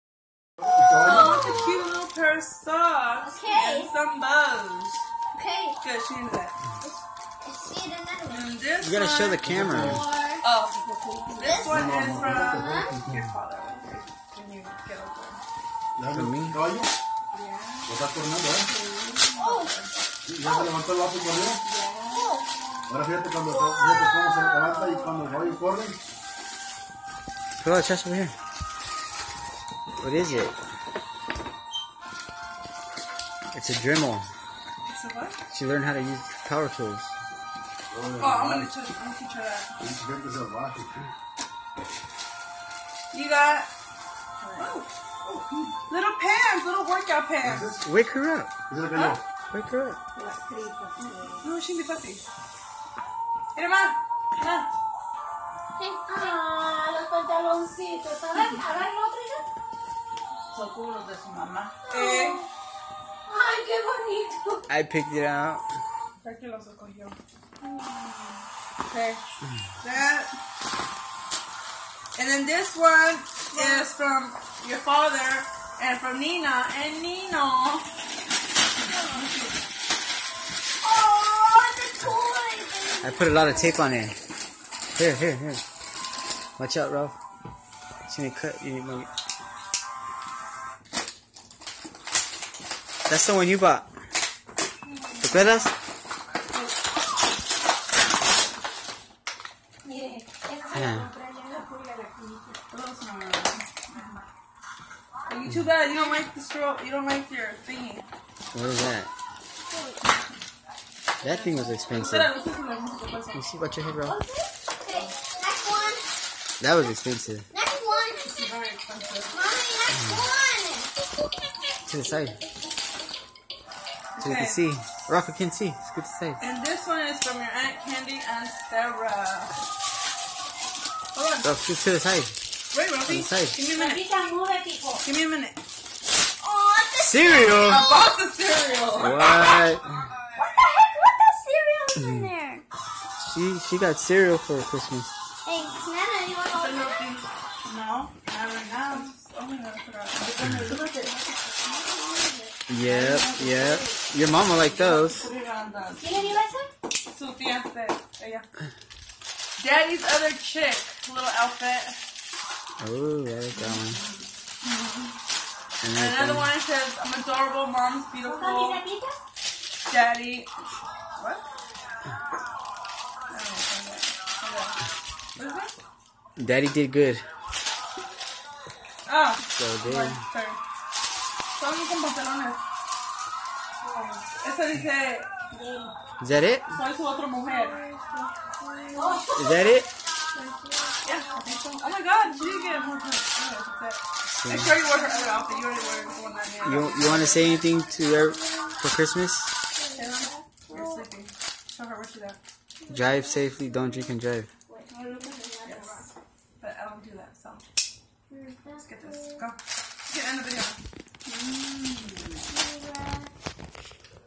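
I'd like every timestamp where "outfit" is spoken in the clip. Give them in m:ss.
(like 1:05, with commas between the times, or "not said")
2:41, 3:15.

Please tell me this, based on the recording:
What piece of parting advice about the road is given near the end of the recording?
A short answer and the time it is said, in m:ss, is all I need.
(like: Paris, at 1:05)
Don't drink and drive, at 3:23.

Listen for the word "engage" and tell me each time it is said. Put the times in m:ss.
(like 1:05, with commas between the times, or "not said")
not said.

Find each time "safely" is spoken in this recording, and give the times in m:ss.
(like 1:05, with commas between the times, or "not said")
3:23.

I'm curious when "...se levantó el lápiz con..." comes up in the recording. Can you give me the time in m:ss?
0:20.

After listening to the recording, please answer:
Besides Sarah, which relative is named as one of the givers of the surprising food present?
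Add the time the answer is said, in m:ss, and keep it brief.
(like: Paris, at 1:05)
Aunt Candy, at 2:07.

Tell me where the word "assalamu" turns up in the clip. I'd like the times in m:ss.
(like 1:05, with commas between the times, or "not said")
not said.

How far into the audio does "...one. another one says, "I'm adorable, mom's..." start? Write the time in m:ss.
2:43.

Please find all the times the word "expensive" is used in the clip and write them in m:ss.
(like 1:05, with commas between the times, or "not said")
1:51, 1:56.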